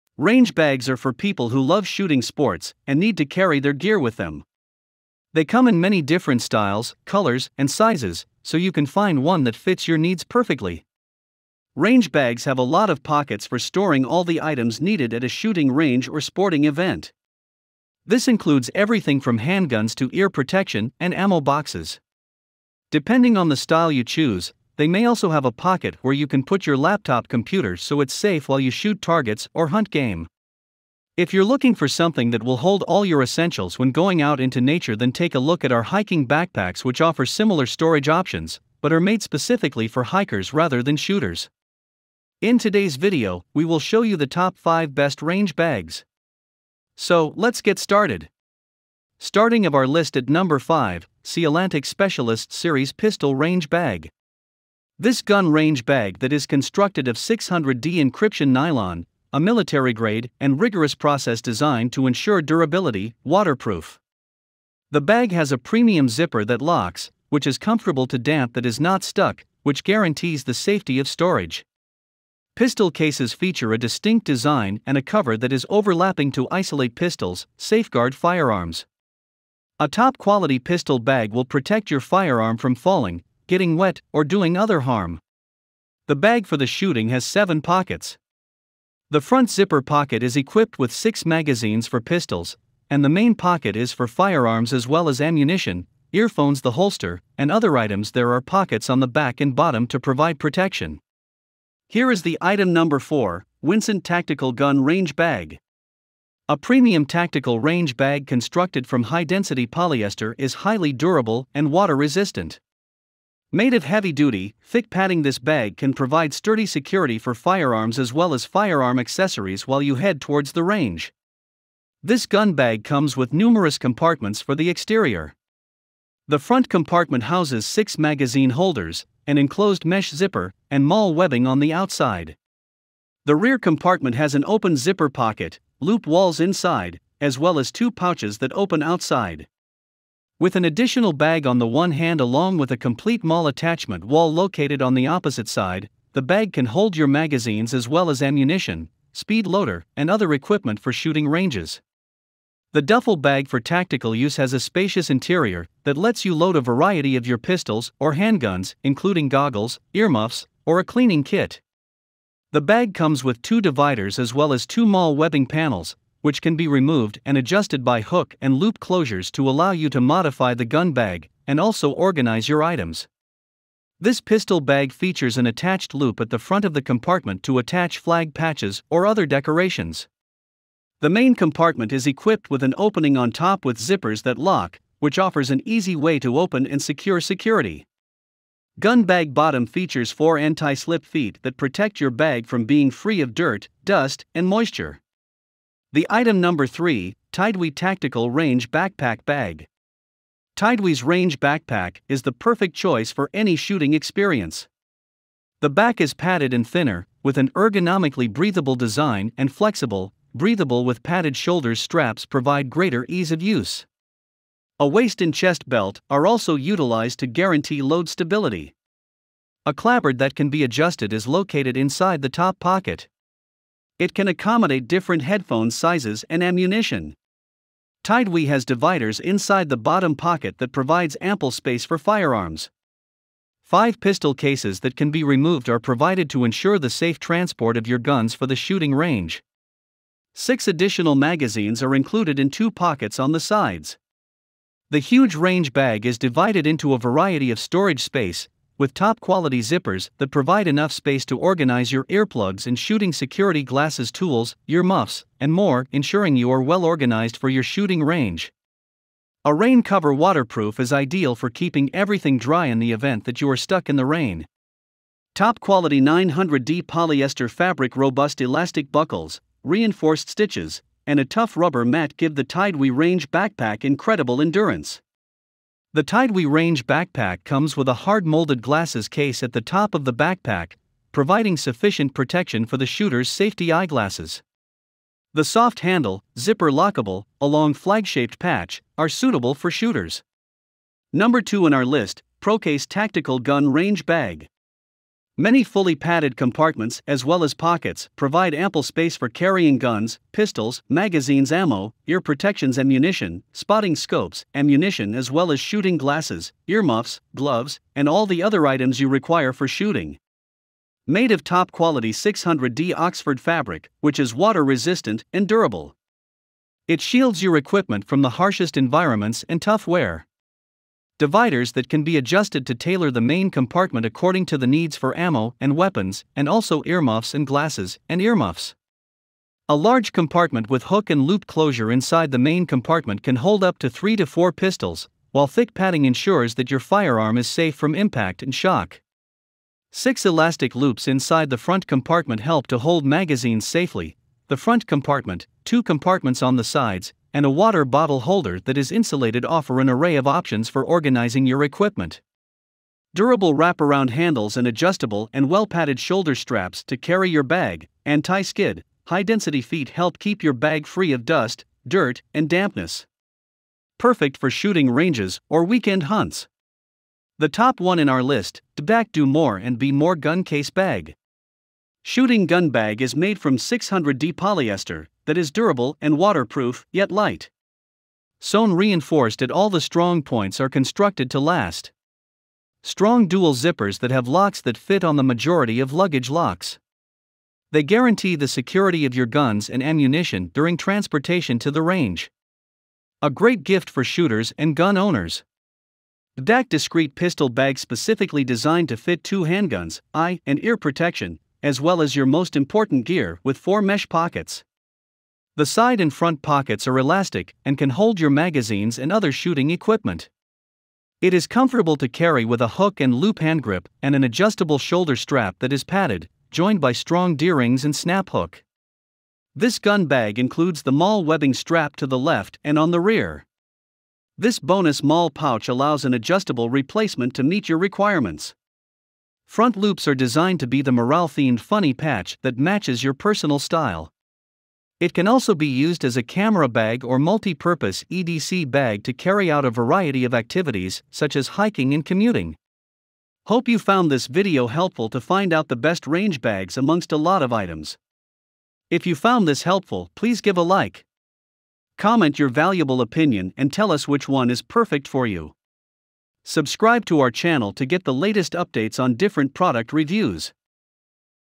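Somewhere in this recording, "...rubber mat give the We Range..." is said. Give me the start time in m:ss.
4:31.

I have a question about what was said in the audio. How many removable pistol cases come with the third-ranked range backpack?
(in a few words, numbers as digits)
5.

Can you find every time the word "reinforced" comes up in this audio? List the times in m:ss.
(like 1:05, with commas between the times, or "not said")
4:29, 6:18.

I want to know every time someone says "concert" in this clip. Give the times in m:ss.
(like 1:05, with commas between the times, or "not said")
not said.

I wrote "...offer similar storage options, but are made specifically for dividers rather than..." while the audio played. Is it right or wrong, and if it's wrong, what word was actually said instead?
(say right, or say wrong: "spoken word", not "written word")
wrong: "hikers", not "dividers".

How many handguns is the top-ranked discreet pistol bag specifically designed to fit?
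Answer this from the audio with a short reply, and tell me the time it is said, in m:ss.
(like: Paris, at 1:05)
2, at 6:39.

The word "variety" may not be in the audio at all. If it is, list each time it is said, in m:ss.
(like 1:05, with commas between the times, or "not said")
2:36, 4:06, 7:19.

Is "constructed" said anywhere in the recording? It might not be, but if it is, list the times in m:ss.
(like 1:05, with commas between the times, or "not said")
0:56, 1:48, 6:20.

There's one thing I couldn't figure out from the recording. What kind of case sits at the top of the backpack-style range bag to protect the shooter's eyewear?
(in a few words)
hard molded glasses case.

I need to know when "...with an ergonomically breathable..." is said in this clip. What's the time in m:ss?
3:27.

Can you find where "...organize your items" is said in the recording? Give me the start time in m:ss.
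2:51.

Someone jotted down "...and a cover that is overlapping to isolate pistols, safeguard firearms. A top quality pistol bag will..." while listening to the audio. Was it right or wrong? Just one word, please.
right.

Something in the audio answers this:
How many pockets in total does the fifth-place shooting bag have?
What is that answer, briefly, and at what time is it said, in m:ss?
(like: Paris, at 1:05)
seven, at 1:27.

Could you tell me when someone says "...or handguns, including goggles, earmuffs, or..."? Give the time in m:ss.
2:37.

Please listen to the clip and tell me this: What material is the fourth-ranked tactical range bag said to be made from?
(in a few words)
high density polyester.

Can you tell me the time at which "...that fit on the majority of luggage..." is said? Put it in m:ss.
6:24.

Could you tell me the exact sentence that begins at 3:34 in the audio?
A waist and chest belt are also utilized to guarantee load stability.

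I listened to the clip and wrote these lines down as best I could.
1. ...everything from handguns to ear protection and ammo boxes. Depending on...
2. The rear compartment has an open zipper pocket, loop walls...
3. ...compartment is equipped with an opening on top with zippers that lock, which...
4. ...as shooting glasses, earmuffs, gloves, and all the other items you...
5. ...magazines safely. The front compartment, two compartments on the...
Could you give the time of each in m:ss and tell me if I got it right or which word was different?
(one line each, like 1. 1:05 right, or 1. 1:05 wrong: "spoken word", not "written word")
1. 0:18 right
2. 2:13 right
3. 3:01 right
4. 5:05 right
5. 5:43 right.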